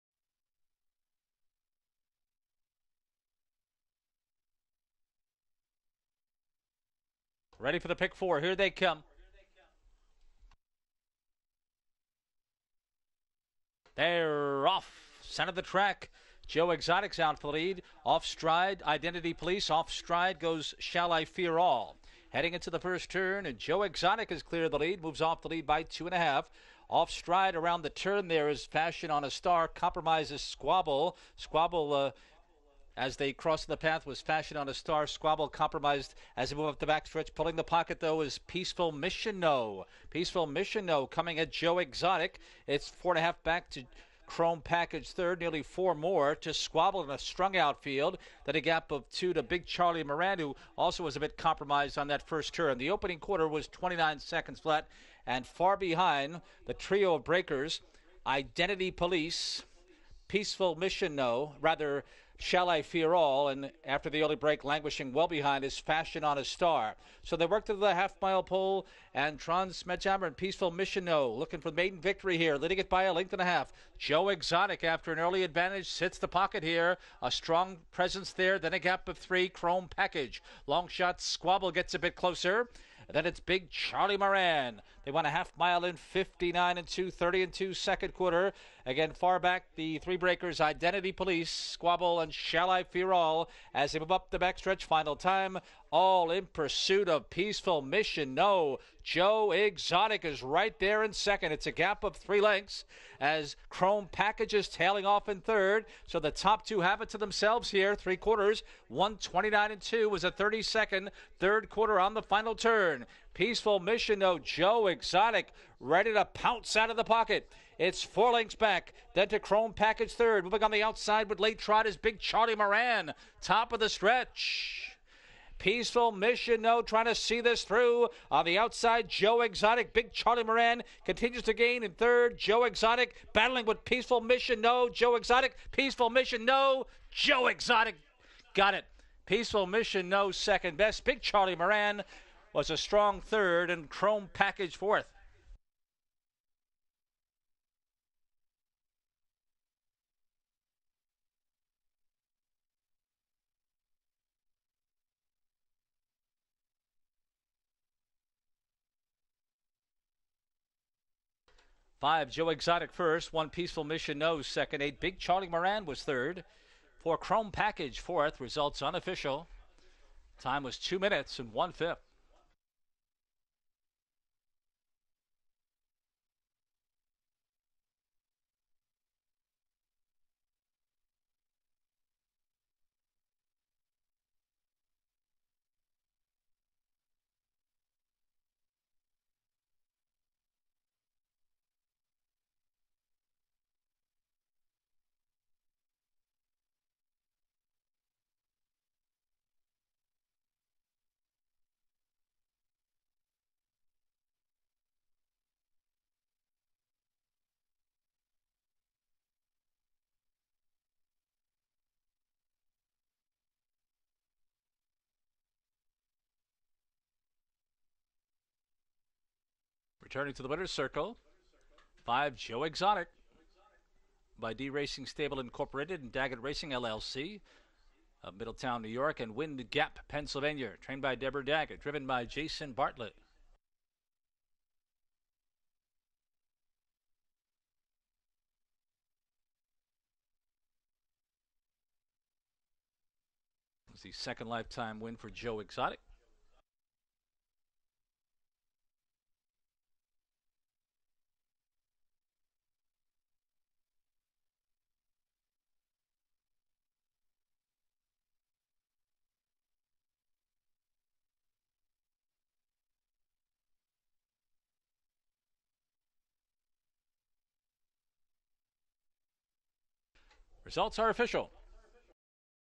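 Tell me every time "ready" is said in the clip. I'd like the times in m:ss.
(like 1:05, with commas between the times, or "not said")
0:07, 1:55.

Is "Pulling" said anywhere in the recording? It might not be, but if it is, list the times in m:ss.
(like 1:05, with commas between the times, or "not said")
0:37.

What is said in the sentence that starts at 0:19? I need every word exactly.
Off stride goes Shall I Fear All.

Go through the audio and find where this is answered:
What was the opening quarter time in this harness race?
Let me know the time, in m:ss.
0:53.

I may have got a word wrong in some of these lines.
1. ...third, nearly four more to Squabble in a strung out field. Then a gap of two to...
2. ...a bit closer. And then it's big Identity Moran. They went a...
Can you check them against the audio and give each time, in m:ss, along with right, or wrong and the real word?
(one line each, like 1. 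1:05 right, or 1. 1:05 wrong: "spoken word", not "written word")
1. 0:45 right
2. 1:21 wrong: "Charlie", not "Identity".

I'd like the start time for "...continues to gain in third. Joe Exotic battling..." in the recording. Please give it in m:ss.
2:11.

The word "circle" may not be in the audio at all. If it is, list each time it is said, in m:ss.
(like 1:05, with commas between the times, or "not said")
3:40.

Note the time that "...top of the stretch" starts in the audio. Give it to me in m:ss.
2:03.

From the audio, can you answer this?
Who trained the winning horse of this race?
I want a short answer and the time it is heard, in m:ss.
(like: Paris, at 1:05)
Deborah Daggett, at 3:51.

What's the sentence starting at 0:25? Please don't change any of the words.
Moves off the lead by two and a half.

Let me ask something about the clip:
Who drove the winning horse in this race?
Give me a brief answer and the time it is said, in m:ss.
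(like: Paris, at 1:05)
Jason Bartlett, at 3:52.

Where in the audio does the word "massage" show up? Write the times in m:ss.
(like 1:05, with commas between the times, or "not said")
not said.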